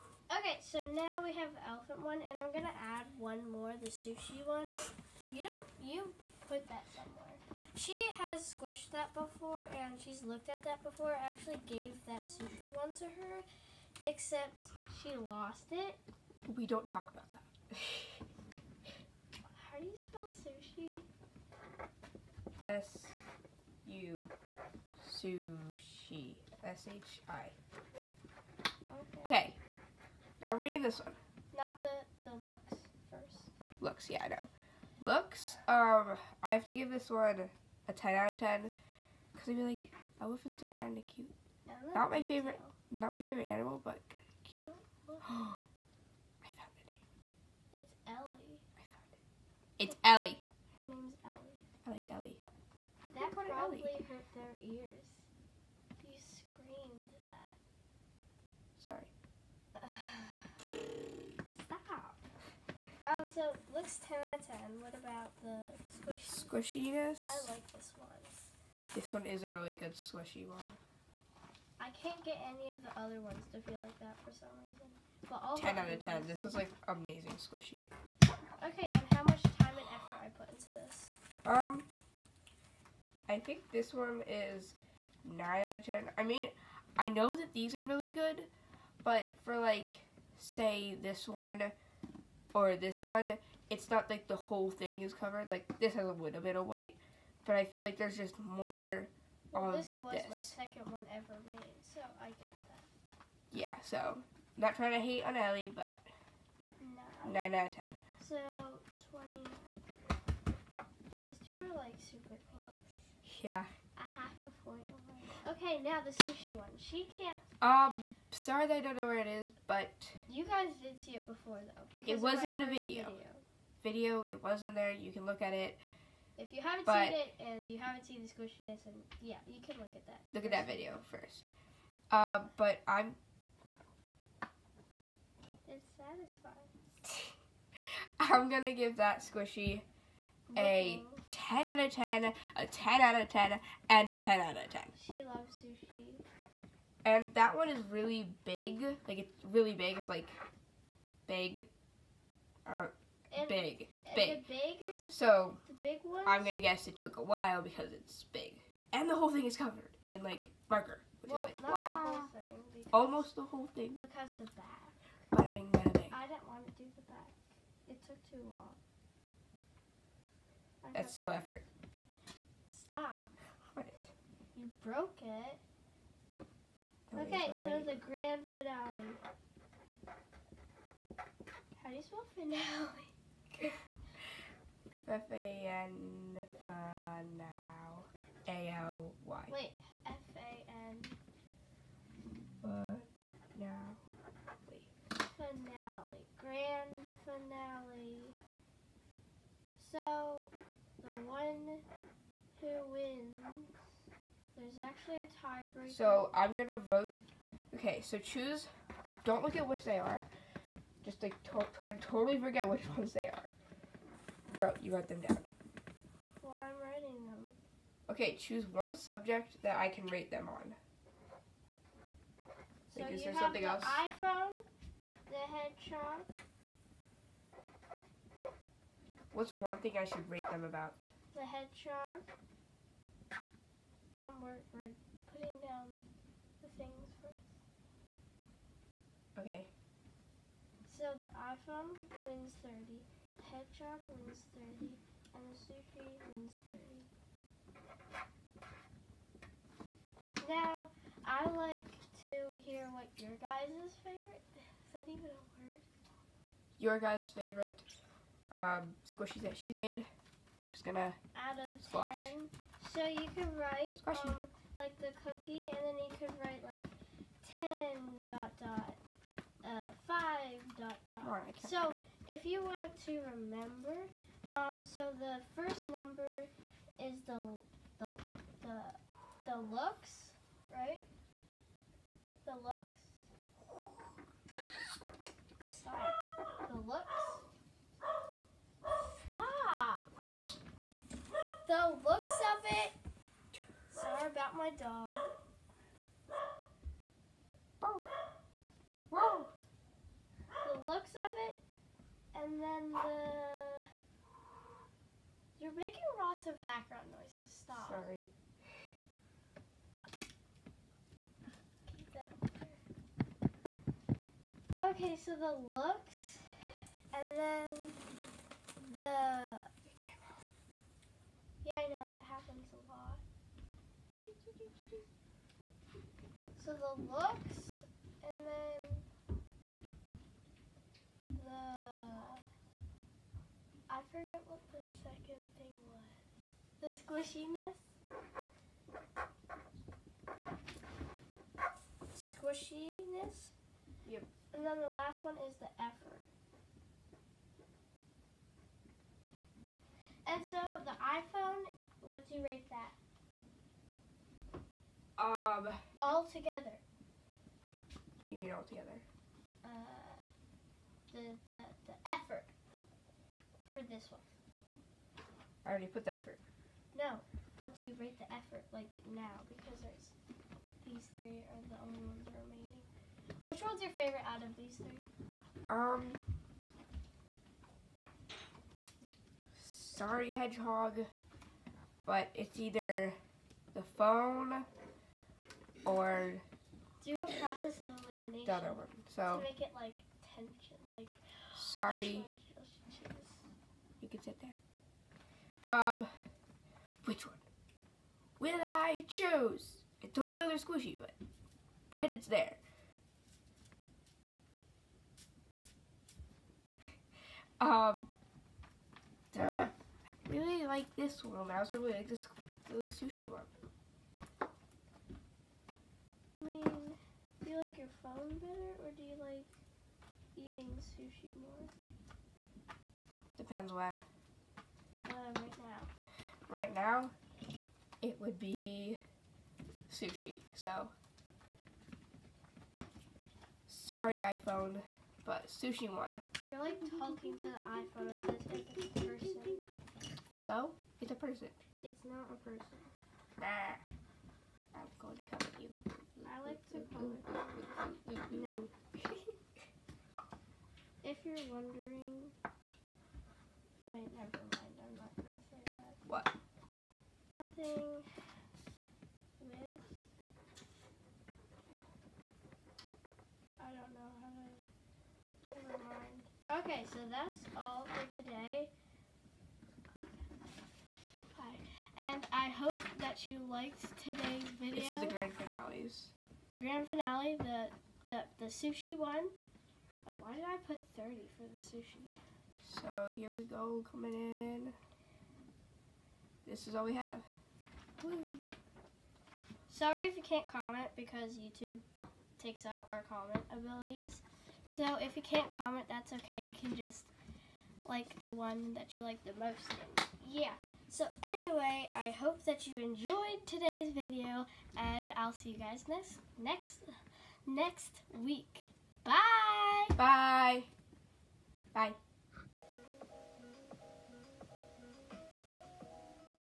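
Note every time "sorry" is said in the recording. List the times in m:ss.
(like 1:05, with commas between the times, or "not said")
0:58, 1:58, 4:45, 5:07, 6:19, 6:31, 7:13, 8:09.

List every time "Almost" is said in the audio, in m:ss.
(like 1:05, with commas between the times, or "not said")
2:42.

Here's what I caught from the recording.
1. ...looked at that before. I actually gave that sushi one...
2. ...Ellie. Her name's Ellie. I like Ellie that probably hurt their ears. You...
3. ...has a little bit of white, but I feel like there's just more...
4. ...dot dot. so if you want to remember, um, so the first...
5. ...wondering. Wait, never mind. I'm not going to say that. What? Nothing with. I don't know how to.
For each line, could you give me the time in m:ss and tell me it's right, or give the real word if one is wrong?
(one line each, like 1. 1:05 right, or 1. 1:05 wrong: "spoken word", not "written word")
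1. 0:10 right
2. 0:50 right
3. 1:35 right
4. 4:30 right
5. 7:31 right.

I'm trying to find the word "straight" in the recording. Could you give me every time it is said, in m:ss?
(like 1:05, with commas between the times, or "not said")
not said.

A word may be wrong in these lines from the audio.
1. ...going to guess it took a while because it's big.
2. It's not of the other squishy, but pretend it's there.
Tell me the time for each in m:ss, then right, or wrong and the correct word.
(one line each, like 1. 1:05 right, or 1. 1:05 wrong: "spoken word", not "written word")
1. 2:36 right
2. 6:40 right.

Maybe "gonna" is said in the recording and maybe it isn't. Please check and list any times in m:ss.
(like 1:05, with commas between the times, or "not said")
0:02, 2:18, 3:26, 4:20.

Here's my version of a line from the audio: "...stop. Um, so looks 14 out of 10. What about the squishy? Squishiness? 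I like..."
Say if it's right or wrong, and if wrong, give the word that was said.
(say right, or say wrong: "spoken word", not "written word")
wrong: "10", not "14".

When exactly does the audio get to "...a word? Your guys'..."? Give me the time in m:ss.
4:15.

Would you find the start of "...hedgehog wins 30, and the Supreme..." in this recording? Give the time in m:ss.
4:03.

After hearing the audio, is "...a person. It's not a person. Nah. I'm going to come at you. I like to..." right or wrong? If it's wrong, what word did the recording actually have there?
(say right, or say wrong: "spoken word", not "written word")
right.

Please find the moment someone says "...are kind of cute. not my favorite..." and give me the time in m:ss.
0:40.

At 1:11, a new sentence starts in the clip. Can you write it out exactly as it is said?
I can't get any of the other ones to feel like that for some reason.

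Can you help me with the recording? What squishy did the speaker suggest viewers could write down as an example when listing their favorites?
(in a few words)
The cookie.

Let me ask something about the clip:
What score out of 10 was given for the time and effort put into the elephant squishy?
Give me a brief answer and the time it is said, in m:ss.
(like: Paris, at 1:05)
9, at 1:23.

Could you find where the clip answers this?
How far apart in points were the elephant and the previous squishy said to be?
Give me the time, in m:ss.
1:53.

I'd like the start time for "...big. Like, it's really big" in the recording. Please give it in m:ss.
2:28.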